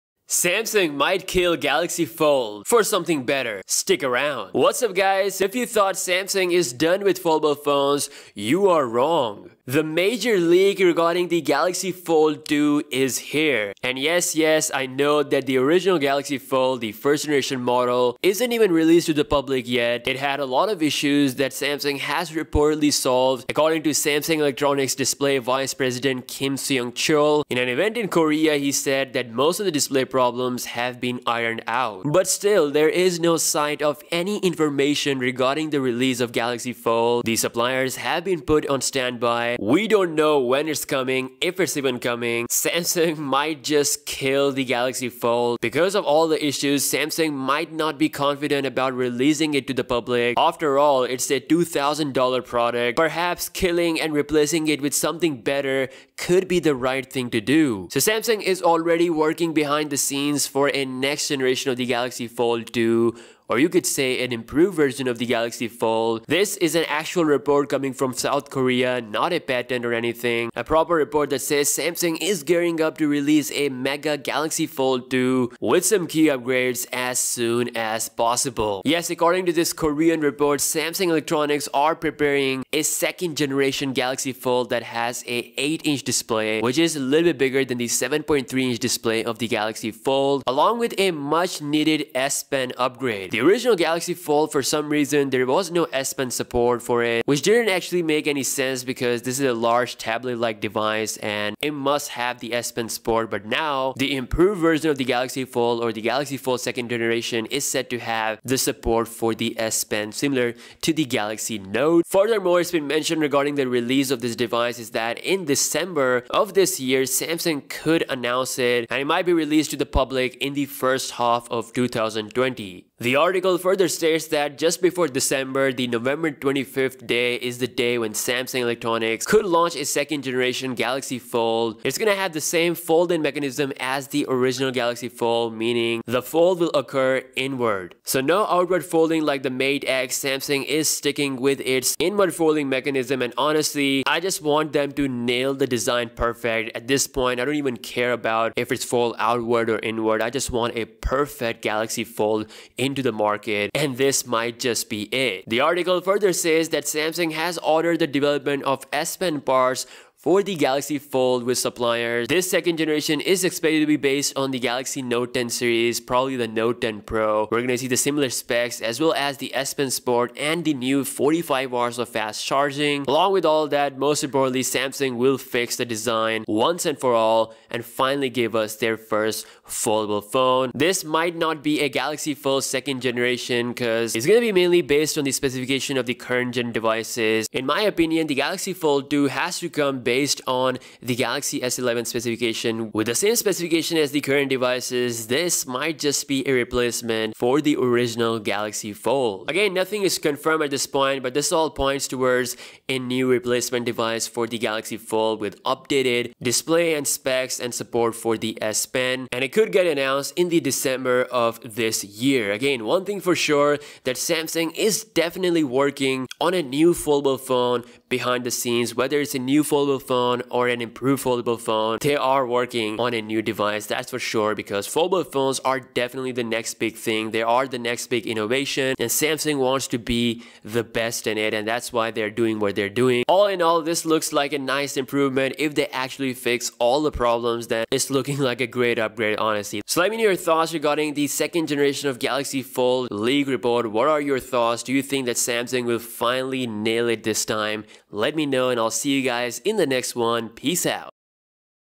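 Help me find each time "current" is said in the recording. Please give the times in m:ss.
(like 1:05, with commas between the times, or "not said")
3:06, 3:14.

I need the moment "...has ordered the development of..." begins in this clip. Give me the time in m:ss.
2:37.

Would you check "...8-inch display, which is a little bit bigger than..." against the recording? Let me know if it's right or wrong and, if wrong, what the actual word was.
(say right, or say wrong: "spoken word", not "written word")
right.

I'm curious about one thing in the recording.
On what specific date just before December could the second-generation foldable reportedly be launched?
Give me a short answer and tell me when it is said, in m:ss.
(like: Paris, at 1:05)
November 25th, at 2:05.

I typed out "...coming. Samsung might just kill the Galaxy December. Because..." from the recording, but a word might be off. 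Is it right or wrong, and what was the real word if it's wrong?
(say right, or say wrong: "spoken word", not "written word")
wrong: "Fold", not "December".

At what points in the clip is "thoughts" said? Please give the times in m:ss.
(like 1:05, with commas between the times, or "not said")
0:05, 4:00, 4:04.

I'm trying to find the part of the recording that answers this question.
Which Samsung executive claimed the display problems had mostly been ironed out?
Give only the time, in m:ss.
0:26.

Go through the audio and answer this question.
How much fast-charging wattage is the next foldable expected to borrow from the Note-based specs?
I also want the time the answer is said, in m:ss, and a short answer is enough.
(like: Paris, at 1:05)
45 watts, at 2:51.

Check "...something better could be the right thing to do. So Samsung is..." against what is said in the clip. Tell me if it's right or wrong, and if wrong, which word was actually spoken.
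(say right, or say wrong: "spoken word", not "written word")
right.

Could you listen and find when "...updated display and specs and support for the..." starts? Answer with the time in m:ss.
3:25.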